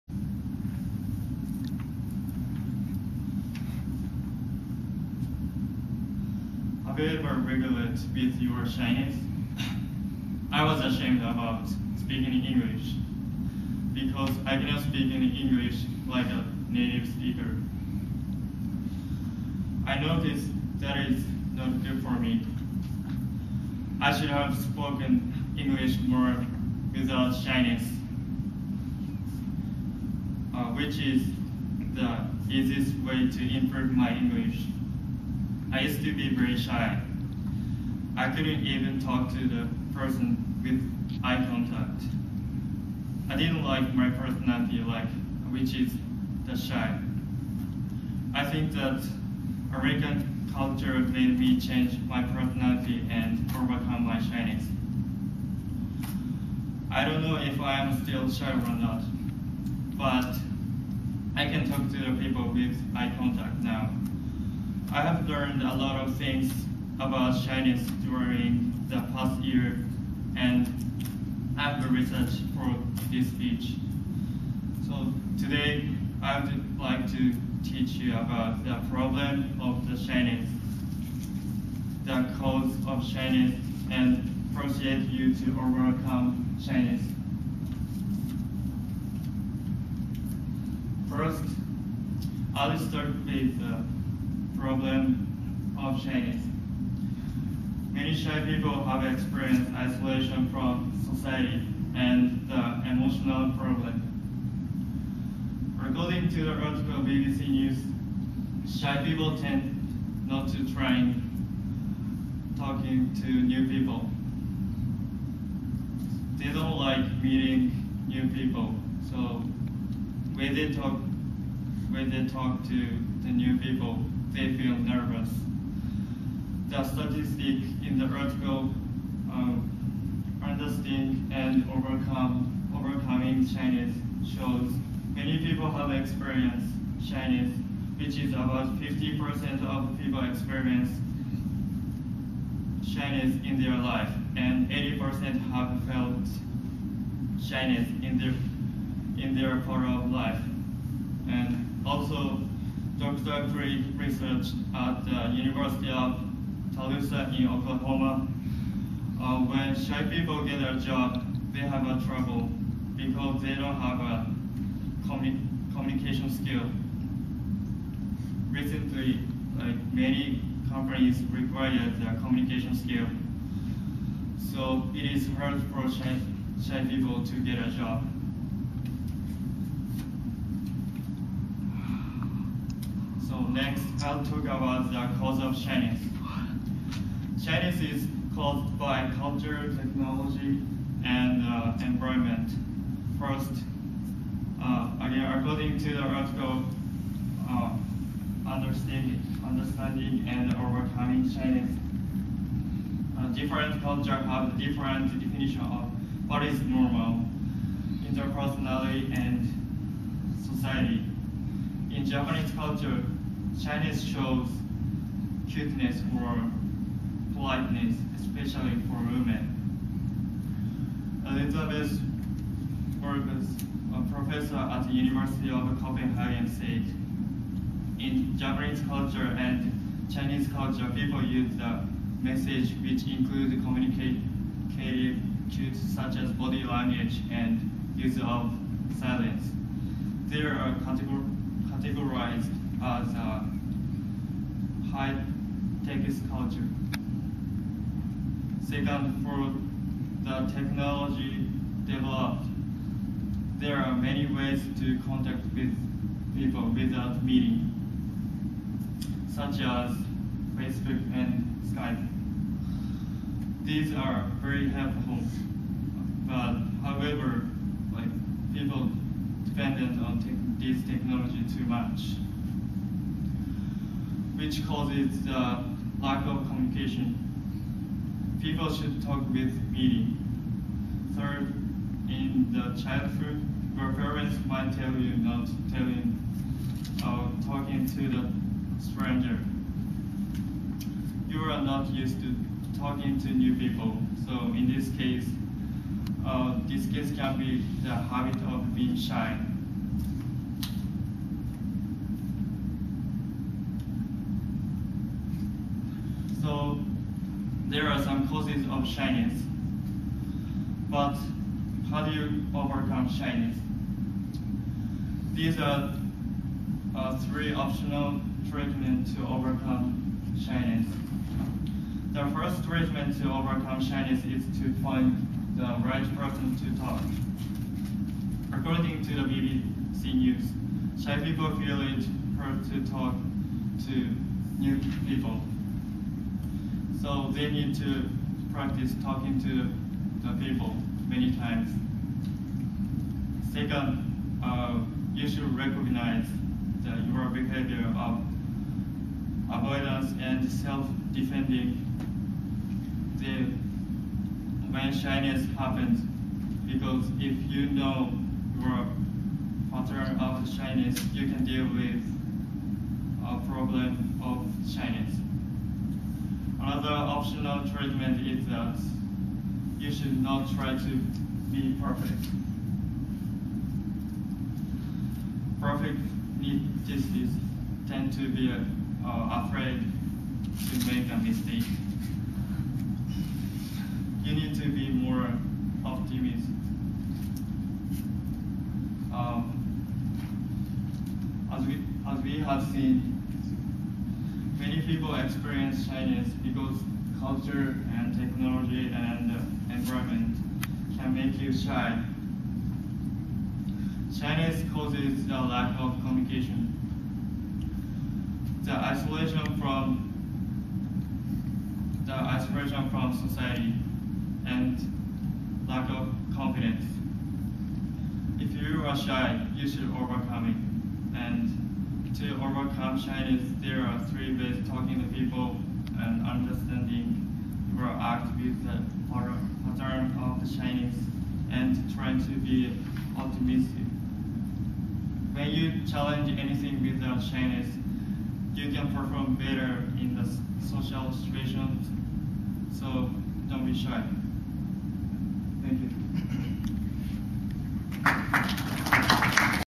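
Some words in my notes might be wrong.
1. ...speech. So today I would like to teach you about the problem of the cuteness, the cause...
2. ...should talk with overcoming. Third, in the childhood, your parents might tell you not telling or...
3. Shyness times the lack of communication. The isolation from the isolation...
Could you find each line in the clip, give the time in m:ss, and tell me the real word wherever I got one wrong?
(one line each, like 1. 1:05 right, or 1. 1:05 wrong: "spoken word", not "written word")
1. 1:13 wrong: "shyness", not "cuteness"
2. 4:38 wrong: "meaning", not "overcoming"
3. 6:44 wrong: "causes", not "times".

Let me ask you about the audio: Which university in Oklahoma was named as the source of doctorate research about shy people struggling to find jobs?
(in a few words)
University of Tulsa.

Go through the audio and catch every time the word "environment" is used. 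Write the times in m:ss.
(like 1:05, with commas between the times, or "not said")
3:11, 6:39.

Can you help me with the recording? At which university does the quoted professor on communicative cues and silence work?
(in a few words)
University of Copenhagen.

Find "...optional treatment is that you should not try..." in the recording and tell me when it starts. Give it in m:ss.
6:07.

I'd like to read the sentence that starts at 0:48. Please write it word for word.
I think that American culture made me change my personality and overcome my shyness.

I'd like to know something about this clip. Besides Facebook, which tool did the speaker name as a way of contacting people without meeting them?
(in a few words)
Skype.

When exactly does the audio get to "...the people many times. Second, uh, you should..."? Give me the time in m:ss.
5:40.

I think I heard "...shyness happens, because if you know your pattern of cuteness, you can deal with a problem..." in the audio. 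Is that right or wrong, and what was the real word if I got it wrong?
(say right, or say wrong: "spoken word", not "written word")
wrong: "shyness", not "cuteness".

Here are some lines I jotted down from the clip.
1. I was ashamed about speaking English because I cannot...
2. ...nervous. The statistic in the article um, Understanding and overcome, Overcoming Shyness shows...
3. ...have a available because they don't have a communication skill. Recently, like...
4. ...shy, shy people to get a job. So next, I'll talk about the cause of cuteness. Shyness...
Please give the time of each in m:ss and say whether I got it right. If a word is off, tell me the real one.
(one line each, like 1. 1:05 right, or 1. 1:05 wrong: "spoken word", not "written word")
1. 0:10 right
2. 2:04 right
3. 2:41 wrong: "trouble", not "available"
4. 2:55 wrong: "shyness", not "cuteness".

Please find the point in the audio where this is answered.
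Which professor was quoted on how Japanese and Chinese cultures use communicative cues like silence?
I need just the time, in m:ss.
3:41.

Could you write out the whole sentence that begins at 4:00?
They are categorized as a high tech culture.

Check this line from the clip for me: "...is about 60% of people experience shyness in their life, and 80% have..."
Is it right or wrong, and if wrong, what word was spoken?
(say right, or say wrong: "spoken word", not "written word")
wrong: "50", not "60".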